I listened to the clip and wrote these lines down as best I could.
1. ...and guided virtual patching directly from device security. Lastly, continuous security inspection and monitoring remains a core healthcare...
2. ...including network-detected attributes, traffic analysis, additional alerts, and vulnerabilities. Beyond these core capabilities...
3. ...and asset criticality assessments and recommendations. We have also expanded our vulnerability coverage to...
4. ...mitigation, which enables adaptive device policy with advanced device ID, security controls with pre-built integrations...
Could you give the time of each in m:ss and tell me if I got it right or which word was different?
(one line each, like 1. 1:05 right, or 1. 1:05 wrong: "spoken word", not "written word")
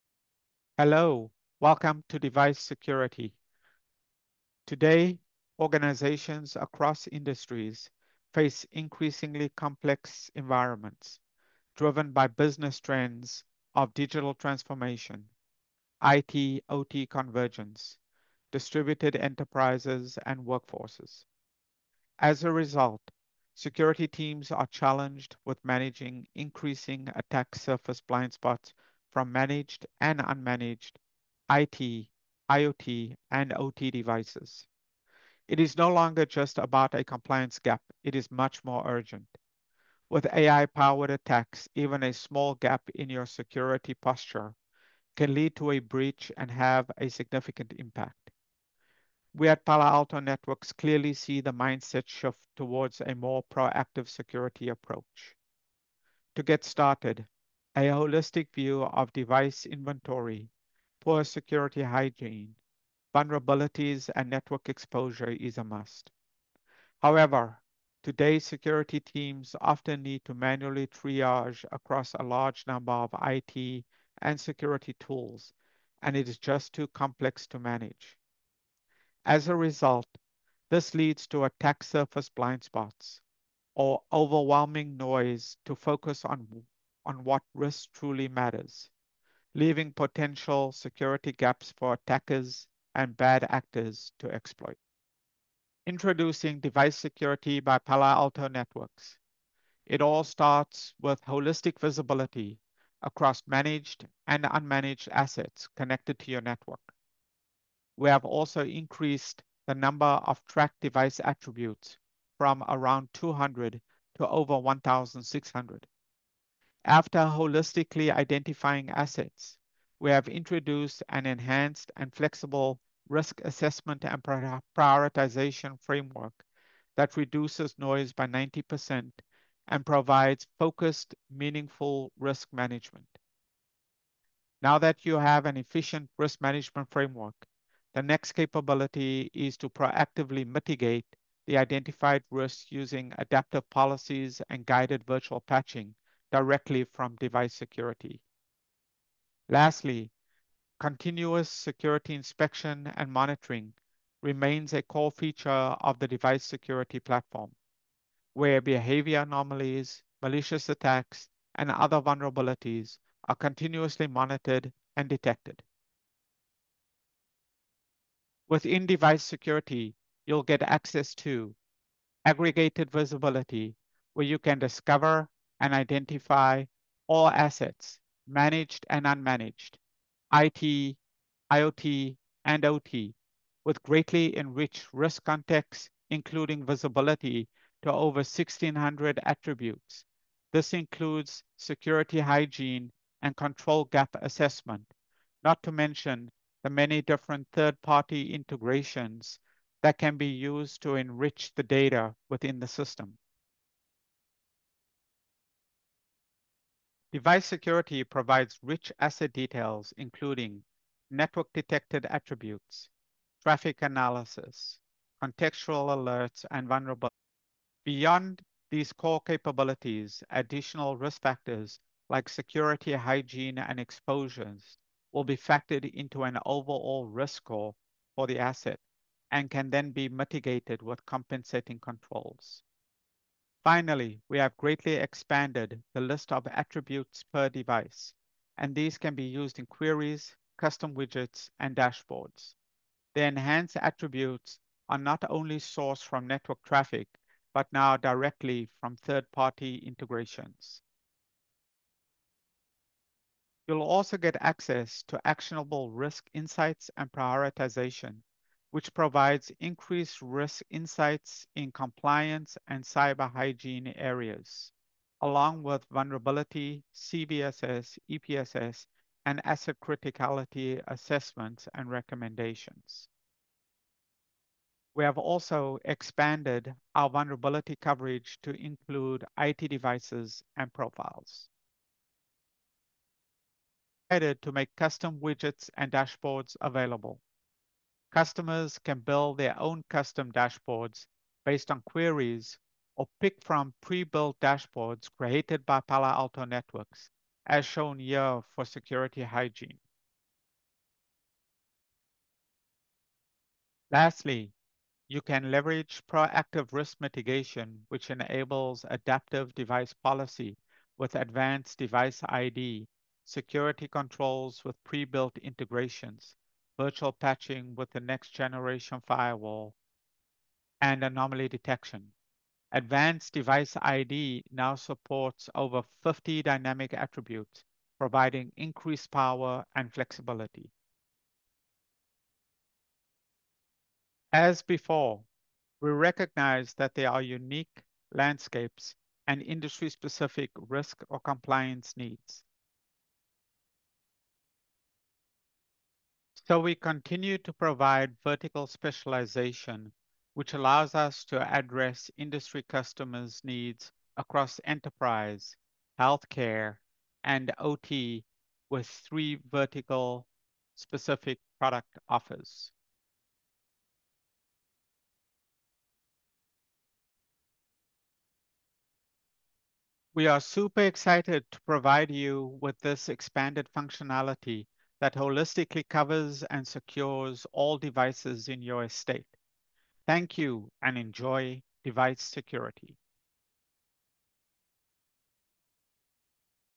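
1. 2:24 wrong: "feature", not "healthcare"
2. 3:29 wrong: "contextual", not "additional"
3. 4:29 right
4. 5:06 right.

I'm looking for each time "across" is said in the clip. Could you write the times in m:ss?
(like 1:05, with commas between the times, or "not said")
0:06, 1:11, 1:43, 5:54.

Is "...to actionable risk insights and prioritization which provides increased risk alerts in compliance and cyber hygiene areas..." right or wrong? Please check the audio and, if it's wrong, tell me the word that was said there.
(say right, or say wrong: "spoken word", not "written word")
wrong: "insights", not "alerts".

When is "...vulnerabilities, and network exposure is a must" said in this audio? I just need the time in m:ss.
1:03.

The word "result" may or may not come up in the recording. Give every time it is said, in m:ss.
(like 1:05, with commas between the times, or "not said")
0:22, 1:19.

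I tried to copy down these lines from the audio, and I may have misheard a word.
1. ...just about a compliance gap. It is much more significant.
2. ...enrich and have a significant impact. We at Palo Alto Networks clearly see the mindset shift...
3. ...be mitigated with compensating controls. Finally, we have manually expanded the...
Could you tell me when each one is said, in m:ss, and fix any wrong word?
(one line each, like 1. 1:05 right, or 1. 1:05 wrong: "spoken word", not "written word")
1. 0:36 wrong: "urgent", not "significant"
2. 0:45 wrong: "breach", not "enrich"
3. 3:49 wrong: "greatly", not "manually".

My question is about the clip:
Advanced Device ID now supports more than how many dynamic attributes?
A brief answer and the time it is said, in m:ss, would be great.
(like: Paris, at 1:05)
50, at 5:25.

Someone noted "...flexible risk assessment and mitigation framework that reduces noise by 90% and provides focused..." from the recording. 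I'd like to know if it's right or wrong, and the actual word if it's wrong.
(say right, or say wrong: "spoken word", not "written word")
wrong: "prioritization", not "mitigation".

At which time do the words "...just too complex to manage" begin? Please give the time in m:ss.
1:16.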